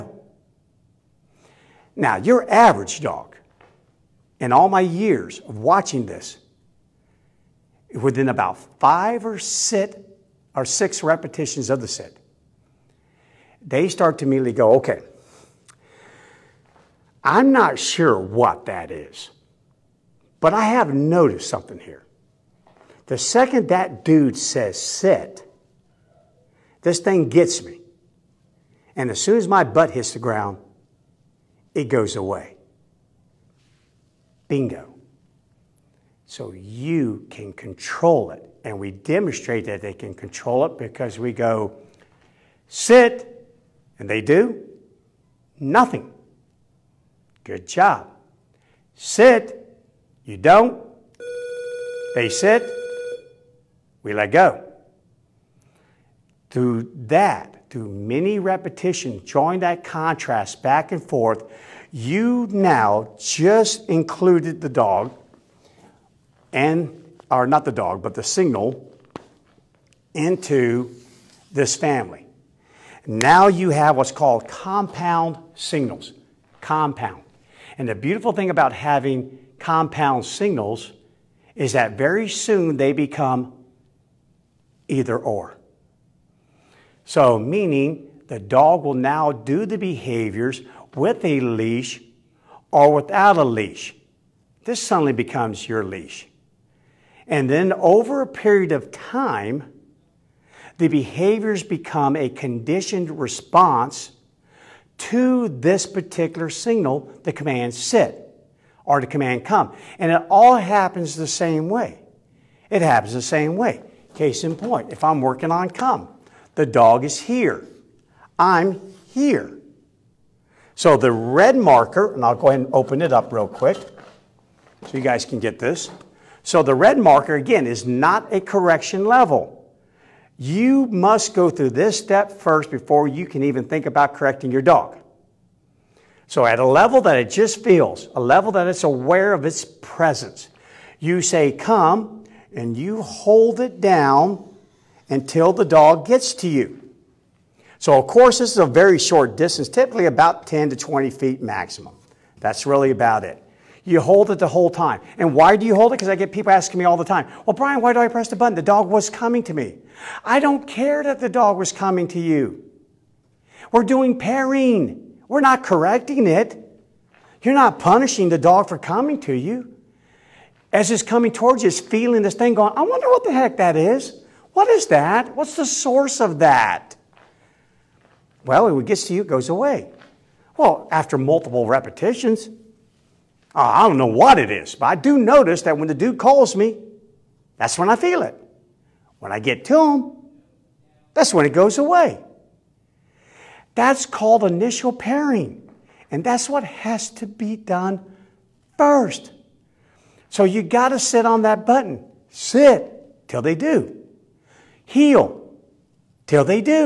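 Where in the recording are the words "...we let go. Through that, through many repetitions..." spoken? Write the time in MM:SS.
00:54.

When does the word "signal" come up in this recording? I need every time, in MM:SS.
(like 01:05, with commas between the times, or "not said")
01:08, 01:15, 01:20, 01:46.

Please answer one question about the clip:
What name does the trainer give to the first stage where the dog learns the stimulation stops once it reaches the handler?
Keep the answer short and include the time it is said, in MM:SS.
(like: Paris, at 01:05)
initial pairing, at 03:14.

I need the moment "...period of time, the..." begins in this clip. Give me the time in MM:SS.
01:38.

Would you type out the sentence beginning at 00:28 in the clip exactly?
And as soon as my butt hits the ground, it goes away.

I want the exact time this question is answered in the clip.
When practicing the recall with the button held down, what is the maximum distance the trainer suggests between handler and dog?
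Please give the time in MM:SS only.
02:30.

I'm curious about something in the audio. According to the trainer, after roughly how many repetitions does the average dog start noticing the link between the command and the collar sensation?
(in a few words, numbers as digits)
5 or 6.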